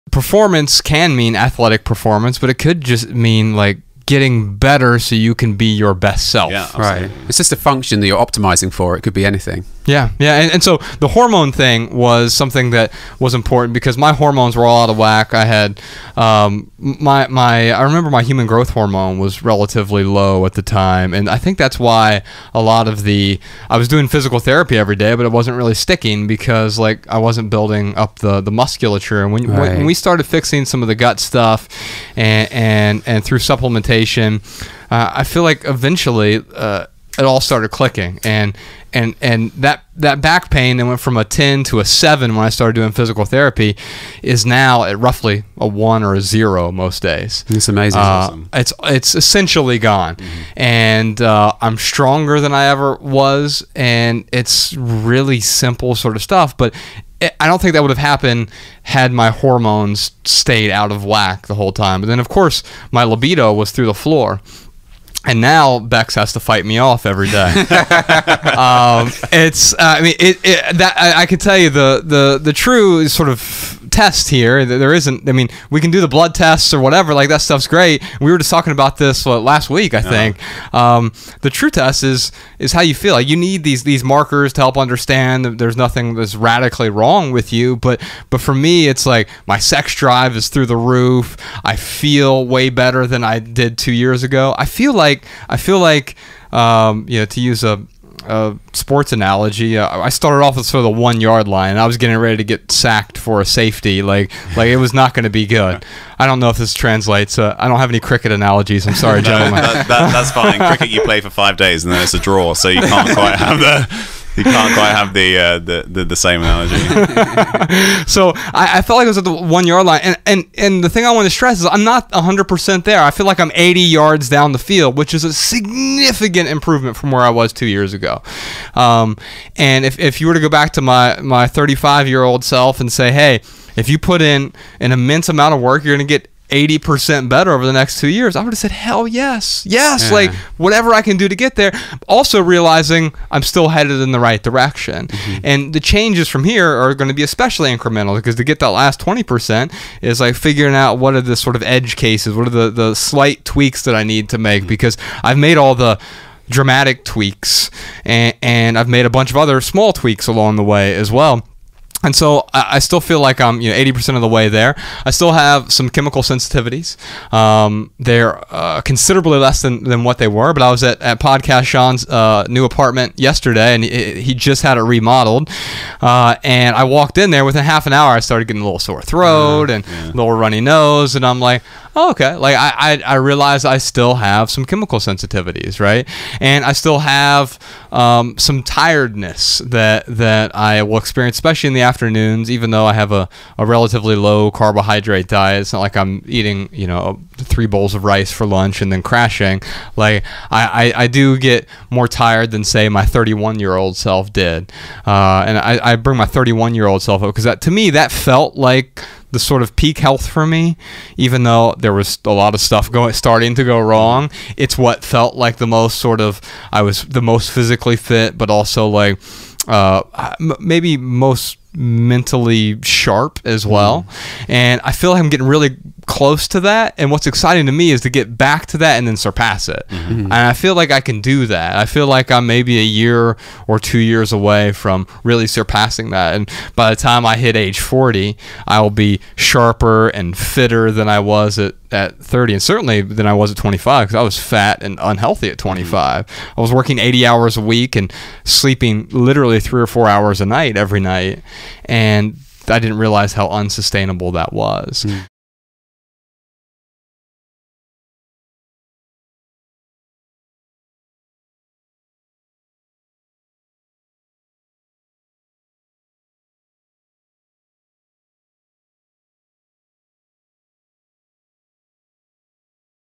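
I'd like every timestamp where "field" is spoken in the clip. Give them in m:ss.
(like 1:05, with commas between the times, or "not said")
2:04.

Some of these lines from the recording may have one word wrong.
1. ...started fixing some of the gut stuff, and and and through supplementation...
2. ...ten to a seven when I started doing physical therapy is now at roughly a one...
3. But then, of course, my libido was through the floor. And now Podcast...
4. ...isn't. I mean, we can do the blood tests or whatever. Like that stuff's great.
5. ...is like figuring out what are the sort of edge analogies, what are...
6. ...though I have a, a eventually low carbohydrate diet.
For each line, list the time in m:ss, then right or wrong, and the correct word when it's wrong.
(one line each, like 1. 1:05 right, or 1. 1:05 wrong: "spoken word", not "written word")
1. 0:29 right
2. 0:41 right
3. 1:02 wrong: "Bex", not "Podcast"
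4. 1:14 right
5. 2:30 wrong: "cases", not "analogies"
6. 3:12 wrong: "relatively", not "eventually".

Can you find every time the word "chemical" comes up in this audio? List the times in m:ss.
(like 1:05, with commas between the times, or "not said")
2:45, 3:04.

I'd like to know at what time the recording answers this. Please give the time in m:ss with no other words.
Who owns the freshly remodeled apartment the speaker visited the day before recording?
2:51.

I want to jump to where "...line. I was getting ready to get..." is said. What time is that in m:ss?
1:41.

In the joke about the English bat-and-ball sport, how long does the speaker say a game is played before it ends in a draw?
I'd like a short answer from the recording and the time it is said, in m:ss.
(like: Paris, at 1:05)
5 days, at 1:51.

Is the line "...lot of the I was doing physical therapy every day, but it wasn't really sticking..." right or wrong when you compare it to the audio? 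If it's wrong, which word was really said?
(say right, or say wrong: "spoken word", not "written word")
right.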